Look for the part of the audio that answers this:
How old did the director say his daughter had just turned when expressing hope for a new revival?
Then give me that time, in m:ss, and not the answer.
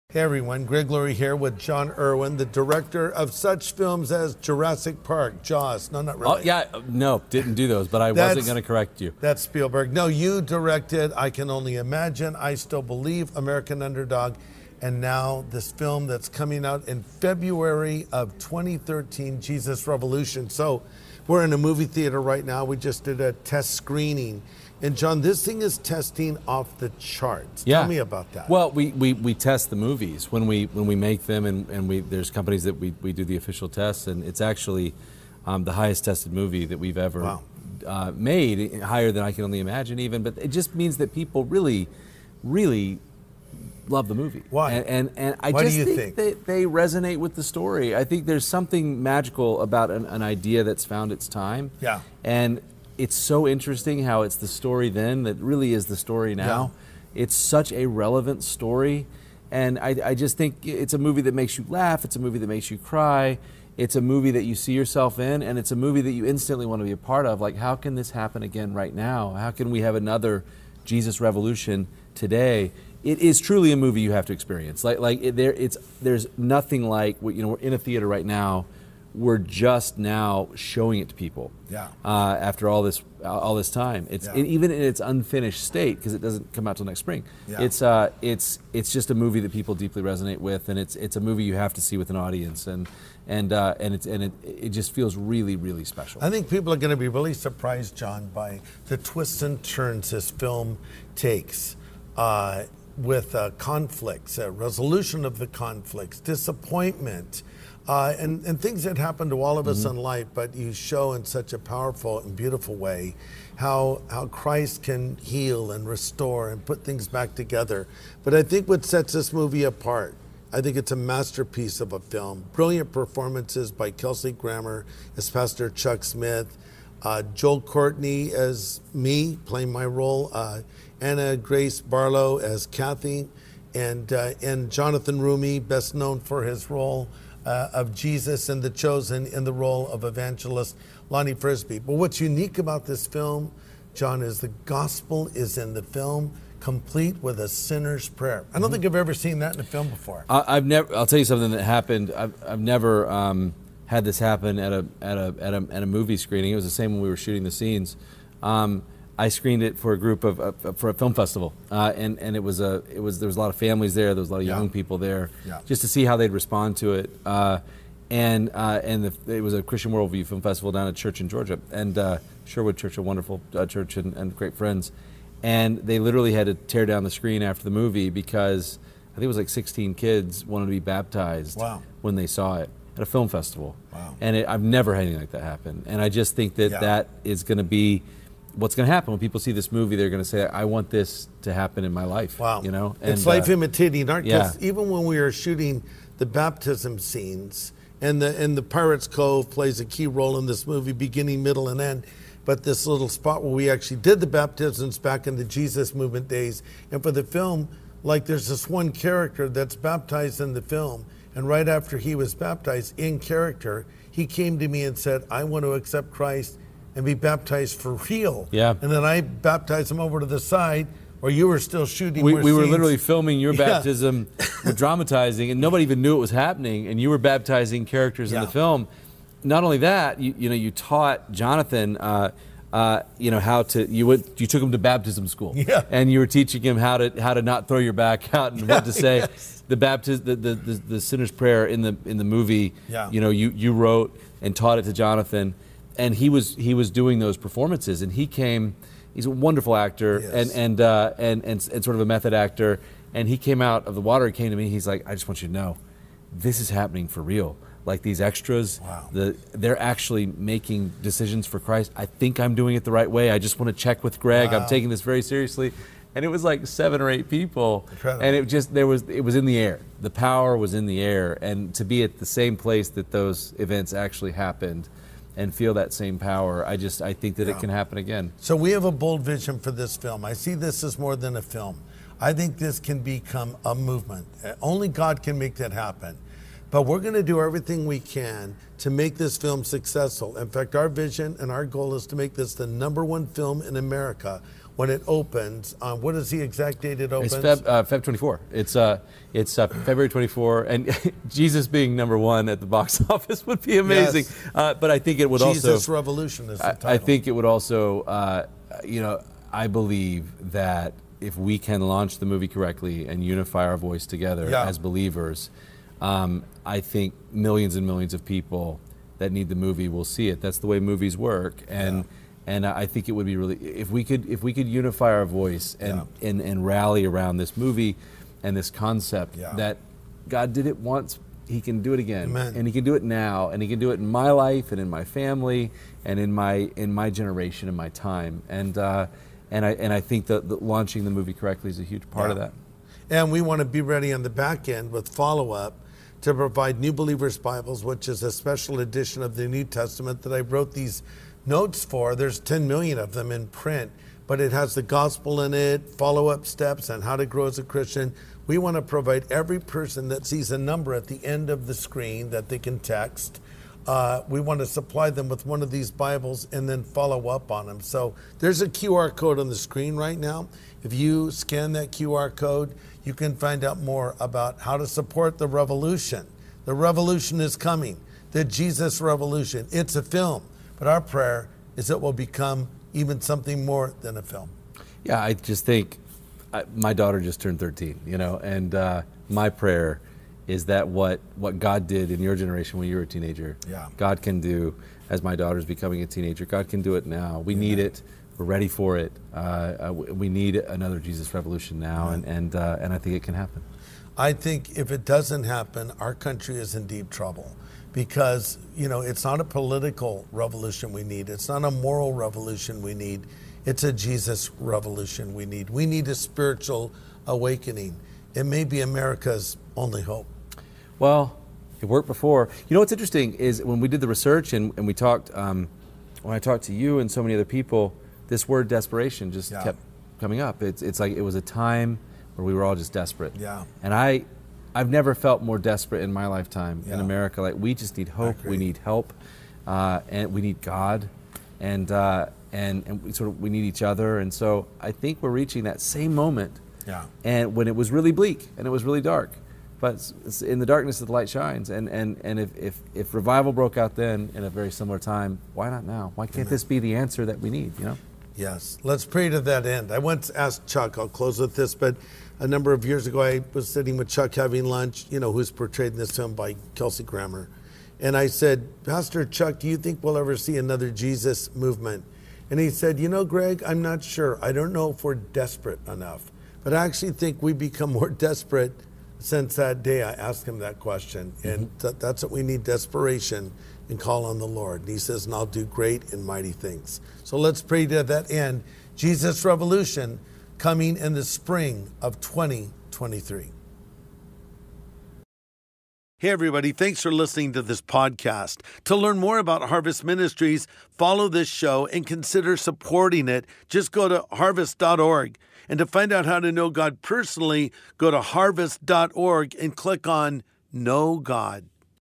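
6:27.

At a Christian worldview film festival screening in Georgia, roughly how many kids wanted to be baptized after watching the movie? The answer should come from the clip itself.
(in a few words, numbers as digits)
16.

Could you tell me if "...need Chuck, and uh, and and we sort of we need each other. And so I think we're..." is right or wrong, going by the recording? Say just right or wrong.
wrong.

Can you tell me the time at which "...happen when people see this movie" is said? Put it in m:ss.
3:08.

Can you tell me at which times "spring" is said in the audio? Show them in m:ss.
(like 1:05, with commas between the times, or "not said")
1:27, 8:11.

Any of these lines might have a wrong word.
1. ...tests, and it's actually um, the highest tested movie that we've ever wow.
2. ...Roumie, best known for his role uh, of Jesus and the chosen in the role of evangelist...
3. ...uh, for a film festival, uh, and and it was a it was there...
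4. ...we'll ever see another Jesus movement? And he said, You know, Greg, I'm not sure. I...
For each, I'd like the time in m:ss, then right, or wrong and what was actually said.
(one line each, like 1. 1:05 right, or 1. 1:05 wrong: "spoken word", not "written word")
1. 0:33 right
2. 2:15 right
3. 2:40 right
4. 7:50 right.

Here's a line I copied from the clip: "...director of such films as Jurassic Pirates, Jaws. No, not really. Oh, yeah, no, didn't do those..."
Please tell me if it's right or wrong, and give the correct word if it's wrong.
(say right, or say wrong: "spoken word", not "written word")
wrong: "Park", not "Pirates".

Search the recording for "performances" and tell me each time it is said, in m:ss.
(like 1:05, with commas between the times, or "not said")
2:02, 4:07.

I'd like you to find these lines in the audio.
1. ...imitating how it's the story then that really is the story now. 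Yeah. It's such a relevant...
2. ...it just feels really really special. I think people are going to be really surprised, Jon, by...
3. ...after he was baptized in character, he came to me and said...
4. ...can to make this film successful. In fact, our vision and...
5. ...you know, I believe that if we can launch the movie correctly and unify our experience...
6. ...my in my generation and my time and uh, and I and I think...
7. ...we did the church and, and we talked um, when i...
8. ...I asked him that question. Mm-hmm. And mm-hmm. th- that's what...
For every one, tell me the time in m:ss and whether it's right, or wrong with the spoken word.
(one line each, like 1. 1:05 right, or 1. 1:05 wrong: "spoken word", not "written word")
1. 0:53 wrong: "interesting", not "imitating"
2. 1:34 right
3. 3:31 right
4. 4:47 right
5. 5:08 wrong: "voice", not "experience"
6. 5:36 right
7. 7:03 wrong: "research", not "church"
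8. 8:00 right.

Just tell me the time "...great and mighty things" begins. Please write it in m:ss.
8:05.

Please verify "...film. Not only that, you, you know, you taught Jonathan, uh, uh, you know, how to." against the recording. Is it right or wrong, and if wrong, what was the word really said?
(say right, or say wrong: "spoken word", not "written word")
right.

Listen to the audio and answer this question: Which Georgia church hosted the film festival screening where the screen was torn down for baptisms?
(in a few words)
Sherwood Church.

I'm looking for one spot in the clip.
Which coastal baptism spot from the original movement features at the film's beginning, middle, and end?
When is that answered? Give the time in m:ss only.
3:18.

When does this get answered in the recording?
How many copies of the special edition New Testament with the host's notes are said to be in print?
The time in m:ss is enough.
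5:52.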